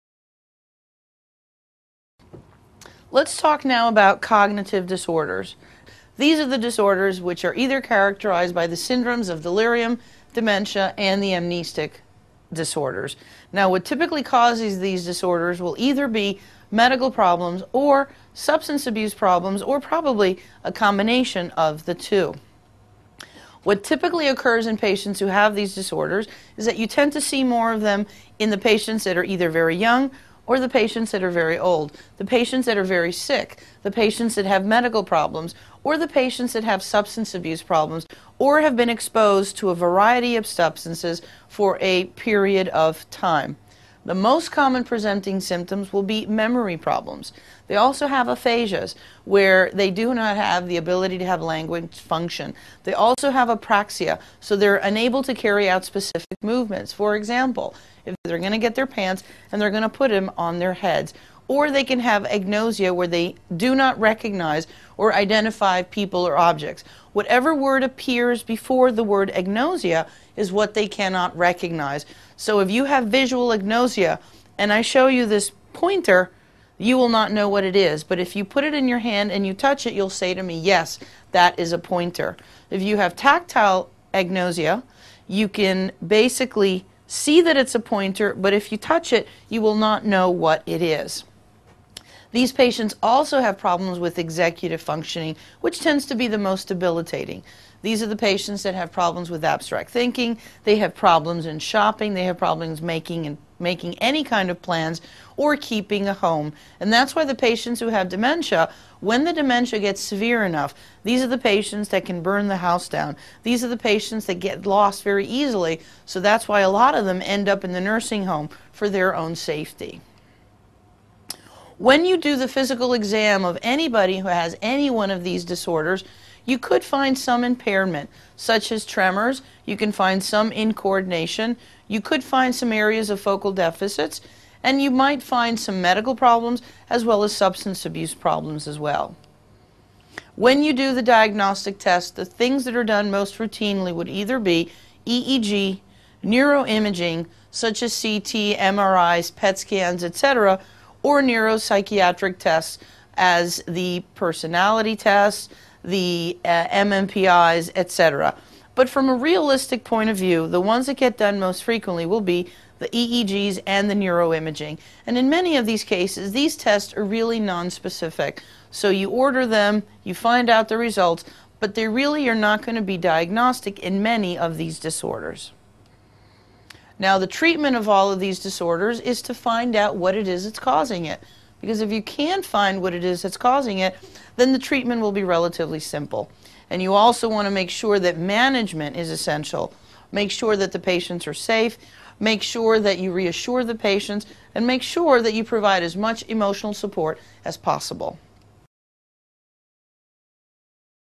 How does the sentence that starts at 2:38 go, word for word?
But from a realistic point of view, the ones that get done most frequently will be the EEGs and the neuroimaging.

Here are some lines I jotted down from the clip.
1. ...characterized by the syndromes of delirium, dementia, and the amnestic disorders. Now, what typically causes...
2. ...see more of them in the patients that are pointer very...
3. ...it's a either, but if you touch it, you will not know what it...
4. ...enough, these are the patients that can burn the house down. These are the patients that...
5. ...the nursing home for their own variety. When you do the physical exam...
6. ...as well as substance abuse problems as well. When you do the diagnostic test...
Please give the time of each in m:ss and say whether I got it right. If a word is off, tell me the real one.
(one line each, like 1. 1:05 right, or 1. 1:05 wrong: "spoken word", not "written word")
1. 0:07 right
2. 0:27 wrong: "either", not "pointer"
3. 1:27 wrong: "pointer", not "either"
4. 1:50 right
5. 1:57 wrong: "safety", not "variety"
6. 2:16 right.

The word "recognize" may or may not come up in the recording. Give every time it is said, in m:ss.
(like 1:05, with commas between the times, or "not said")
1:03, 1:11.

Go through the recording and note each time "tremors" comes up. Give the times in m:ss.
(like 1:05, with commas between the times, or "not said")
2:08.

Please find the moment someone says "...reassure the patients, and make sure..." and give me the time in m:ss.
3:13.